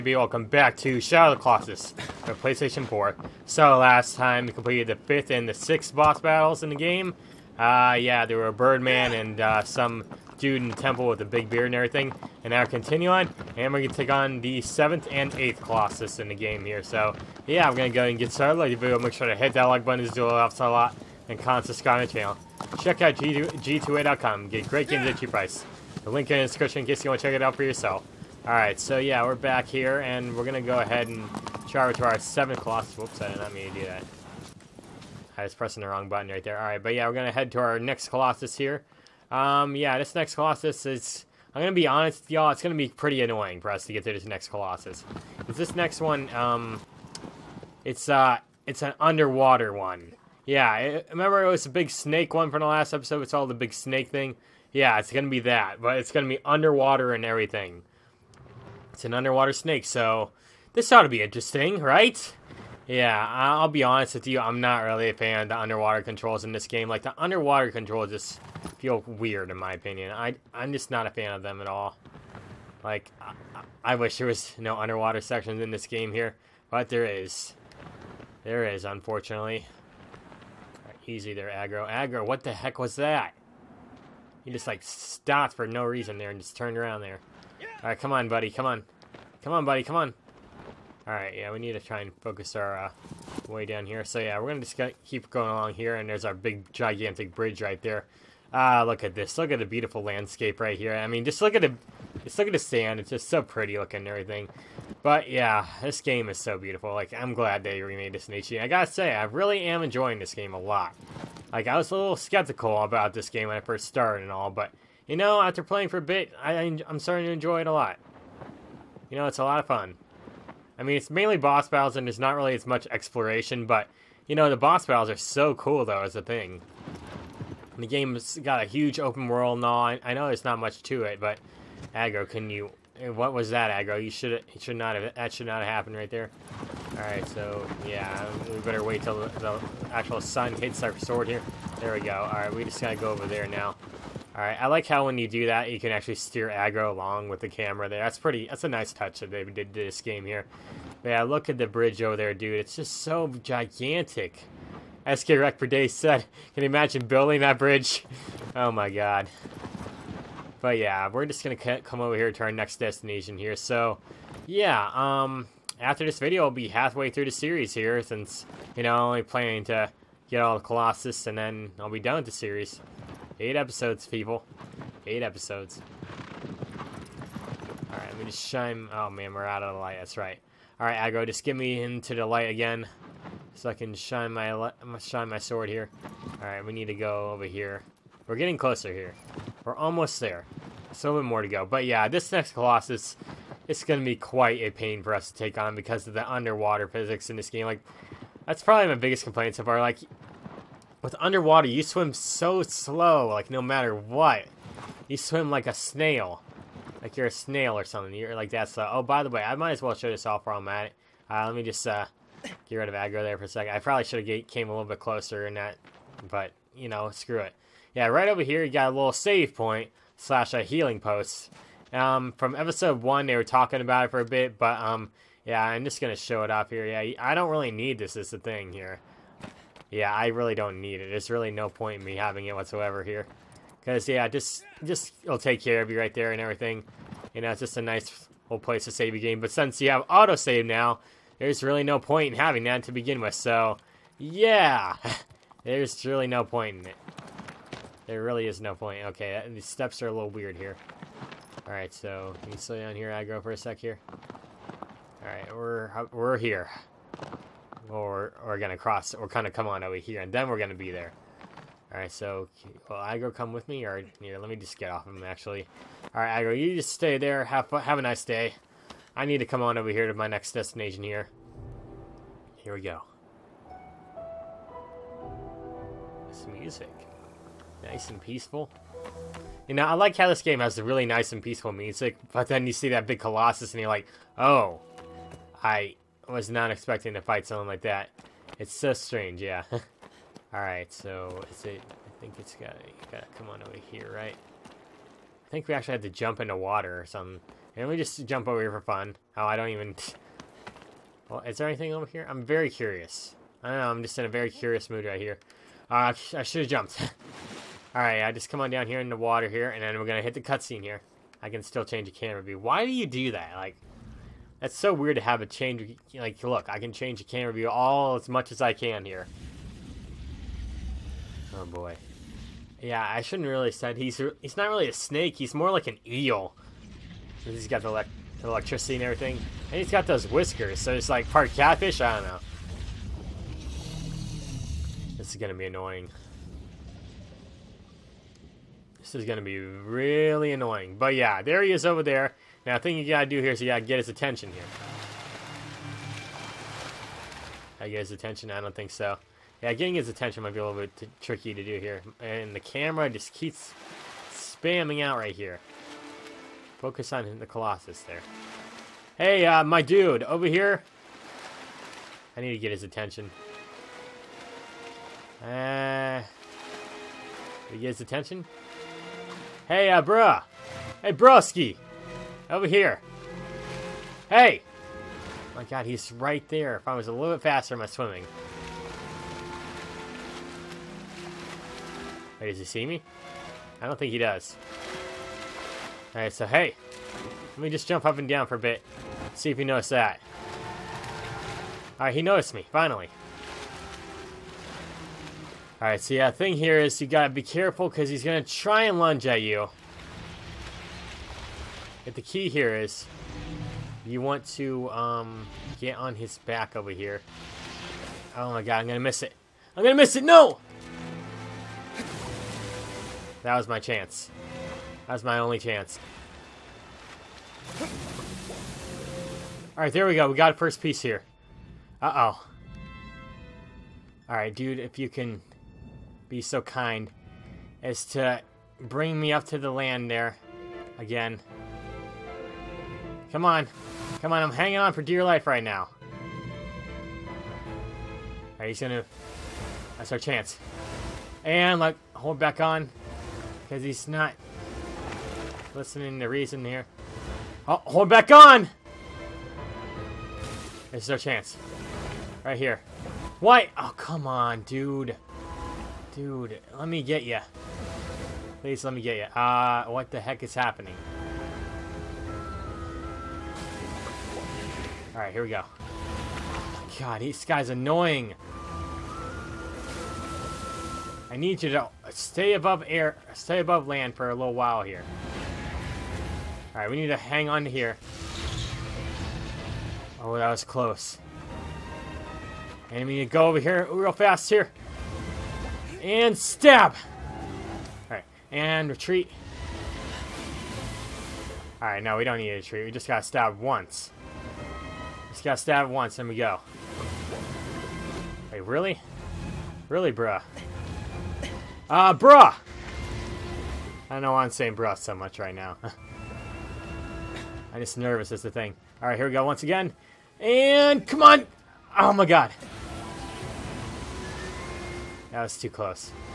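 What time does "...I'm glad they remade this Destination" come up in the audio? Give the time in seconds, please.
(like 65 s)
107 s.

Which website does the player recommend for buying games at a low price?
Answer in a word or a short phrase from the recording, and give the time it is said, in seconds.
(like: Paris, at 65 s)
G2A.com, at 23 s.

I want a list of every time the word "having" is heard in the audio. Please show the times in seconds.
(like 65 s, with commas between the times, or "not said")
232 s, 242 s.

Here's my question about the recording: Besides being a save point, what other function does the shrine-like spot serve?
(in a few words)
healing post.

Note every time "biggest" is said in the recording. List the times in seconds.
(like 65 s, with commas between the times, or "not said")
198 s.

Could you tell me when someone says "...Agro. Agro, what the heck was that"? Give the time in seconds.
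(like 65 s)
81 s.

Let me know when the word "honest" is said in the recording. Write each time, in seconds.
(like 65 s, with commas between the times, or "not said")
41 s, 63 s.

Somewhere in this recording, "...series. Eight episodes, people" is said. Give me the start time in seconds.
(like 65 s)
172 s.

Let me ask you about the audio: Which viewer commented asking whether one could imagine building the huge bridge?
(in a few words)
SK Rec per day.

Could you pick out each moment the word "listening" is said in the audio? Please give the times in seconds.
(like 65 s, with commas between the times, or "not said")
445 s.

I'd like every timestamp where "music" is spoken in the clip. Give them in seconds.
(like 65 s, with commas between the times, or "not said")
276 s, 281 s.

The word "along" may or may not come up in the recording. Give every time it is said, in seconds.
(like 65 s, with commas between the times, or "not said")
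95 s, 146 s.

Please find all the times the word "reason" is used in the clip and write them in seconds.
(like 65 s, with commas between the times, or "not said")
85 s, 446 s.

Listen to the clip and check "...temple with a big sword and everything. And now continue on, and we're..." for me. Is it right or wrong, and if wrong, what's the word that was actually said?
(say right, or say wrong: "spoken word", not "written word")
wrong: "beard", not "sword".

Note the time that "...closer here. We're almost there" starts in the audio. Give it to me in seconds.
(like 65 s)
188 s.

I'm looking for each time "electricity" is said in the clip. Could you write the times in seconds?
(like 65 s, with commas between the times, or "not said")
328 s.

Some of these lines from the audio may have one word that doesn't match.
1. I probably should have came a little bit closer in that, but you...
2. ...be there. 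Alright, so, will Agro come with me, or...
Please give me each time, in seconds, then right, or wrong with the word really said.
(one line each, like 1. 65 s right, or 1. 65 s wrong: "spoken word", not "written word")
1. 213 s right
2. 260 s right.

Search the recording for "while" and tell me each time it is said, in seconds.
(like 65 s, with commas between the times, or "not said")
210 s, 474 s.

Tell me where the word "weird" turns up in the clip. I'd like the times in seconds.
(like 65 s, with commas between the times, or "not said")
69 s, 250 s, 314 s.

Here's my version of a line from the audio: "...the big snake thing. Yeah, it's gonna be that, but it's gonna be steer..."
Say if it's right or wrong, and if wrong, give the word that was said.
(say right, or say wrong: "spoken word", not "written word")
wrong: "underwater", not "steer".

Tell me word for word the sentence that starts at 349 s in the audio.
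Yeah, getting his attention might be a little bit tricky to do here.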